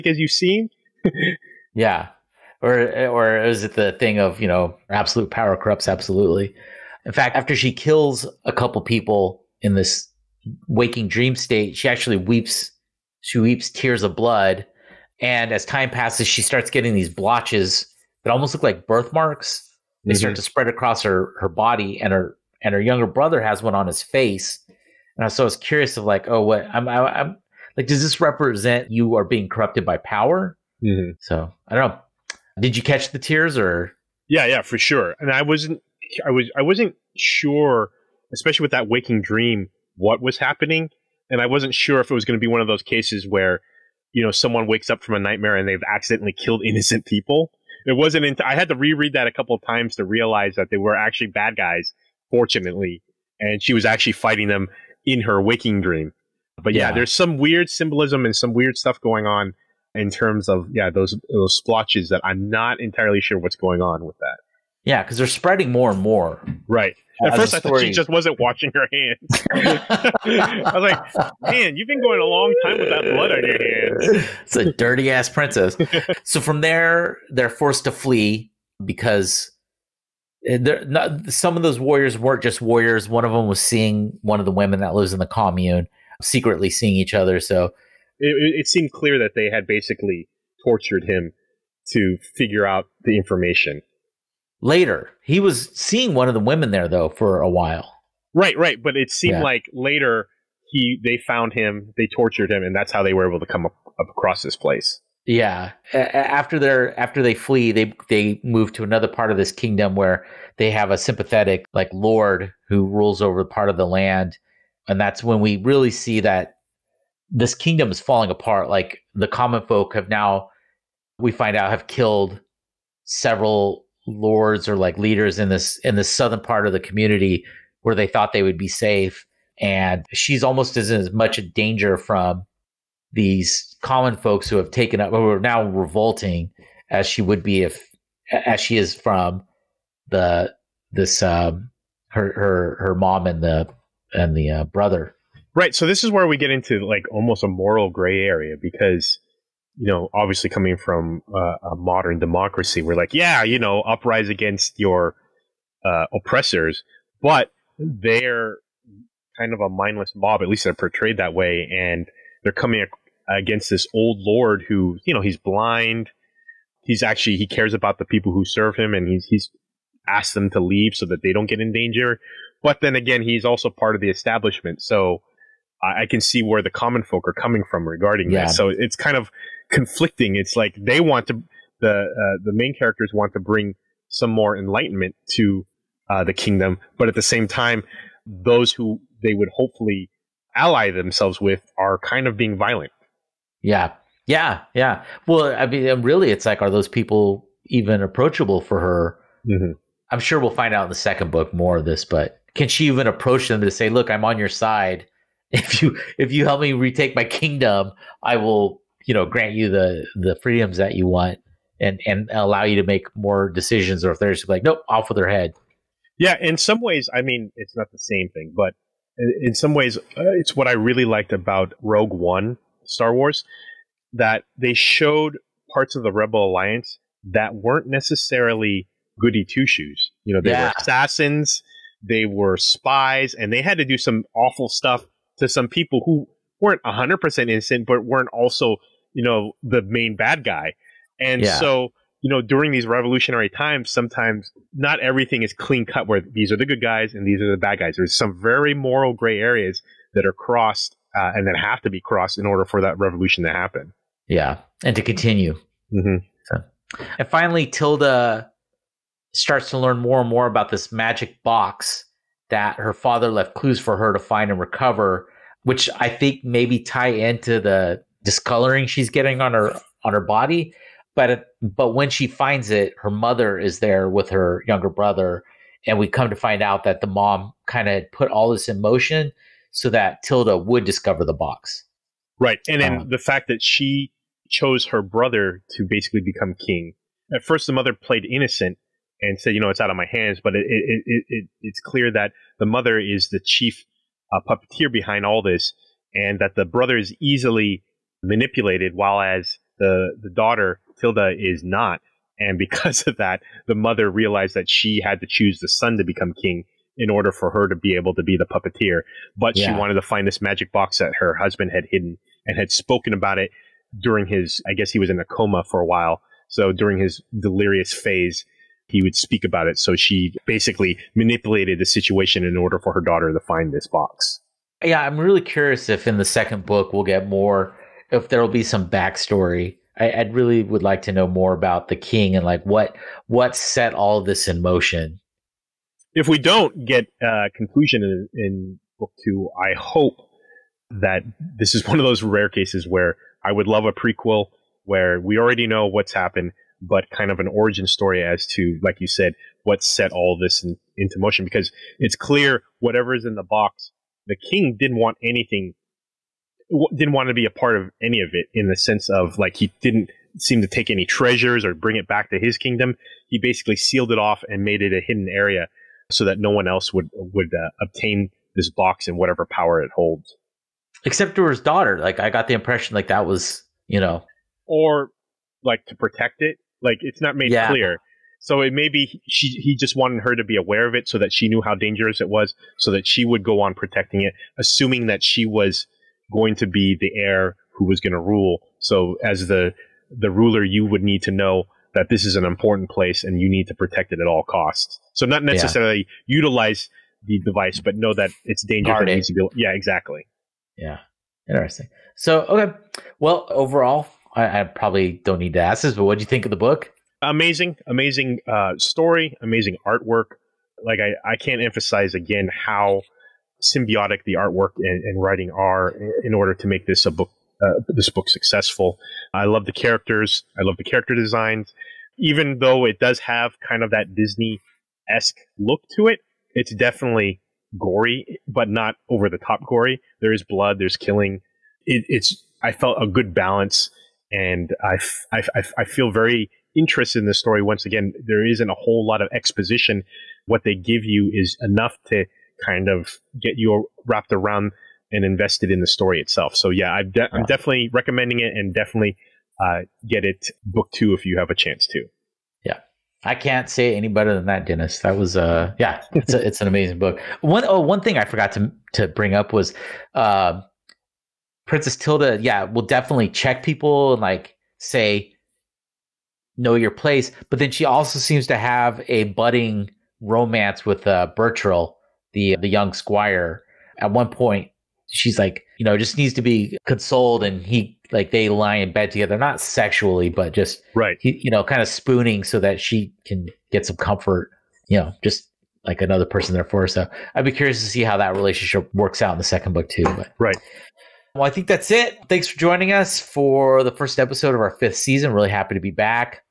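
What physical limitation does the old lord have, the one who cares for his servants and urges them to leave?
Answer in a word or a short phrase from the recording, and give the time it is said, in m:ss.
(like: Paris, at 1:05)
He's blind, at 2:45.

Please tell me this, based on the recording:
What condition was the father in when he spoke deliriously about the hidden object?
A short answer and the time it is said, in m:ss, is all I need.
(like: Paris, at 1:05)
A coma, at 5:15.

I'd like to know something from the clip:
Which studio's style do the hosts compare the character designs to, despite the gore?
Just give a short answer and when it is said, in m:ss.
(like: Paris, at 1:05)
Disney, at 7:04.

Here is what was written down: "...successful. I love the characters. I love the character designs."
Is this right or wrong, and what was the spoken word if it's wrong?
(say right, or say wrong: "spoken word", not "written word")
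right.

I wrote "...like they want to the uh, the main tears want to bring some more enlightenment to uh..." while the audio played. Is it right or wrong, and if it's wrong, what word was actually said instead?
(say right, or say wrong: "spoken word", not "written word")
wrong: "characters", not "tears".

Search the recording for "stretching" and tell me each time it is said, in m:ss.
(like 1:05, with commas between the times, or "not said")
not said.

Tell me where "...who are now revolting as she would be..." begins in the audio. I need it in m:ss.
2:15.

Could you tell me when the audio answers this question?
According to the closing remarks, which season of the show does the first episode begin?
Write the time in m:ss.
8:14.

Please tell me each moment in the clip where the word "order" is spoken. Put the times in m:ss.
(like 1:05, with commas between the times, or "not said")
4:12, 5:07, 5:22, 6:56.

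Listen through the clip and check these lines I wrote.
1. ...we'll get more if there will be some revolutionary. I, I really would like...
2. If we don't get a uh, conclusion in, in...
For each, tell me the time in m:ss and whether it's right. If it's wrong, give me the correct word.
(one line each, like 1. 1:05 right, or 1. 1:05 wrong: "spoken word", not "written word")
1. 5:26 wrong: "backstory", not "revolutionary"
2. 5:36 right.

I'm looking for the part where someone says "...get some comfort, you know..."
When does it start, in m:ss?
8:03.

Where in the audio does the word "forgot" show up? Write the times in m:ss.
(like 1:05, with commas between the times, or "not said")
7:38.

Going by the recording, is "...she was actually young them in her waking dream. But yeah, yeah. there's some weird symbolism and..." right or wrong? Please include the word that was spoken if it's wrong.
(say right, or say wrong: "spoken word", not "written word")
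wrong: "fighting", not "young".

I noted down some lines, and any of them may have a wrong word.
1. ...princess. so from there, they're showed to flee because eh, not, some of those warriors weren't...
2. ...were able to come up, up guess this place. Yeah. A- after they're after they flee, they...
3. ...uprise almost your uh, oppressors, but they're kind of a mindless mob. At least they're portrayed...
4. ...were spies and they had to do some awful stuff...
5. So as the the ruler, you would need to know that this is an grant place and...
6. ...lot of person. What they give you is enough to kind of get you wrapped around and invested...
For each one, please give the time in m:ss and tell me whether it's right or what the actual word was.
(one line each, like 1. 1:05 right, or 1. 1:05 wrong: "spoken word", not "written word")
1. 1:15 wrong: "forced", not "showed"
2. 1:43 wrong: "across", not "guess"
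3. 2:33 wrong: "against", not "almost"
4. 3:52 right
5. 6:28 wrong: "important", not "grant"
6. 7:19 wrong: "exposition", not "person".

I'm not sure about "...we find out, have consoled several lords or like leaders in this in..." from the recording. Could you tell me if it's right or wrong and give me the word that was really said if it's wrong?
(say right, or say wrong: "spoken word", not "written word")
wrong: "killed", not "consoled".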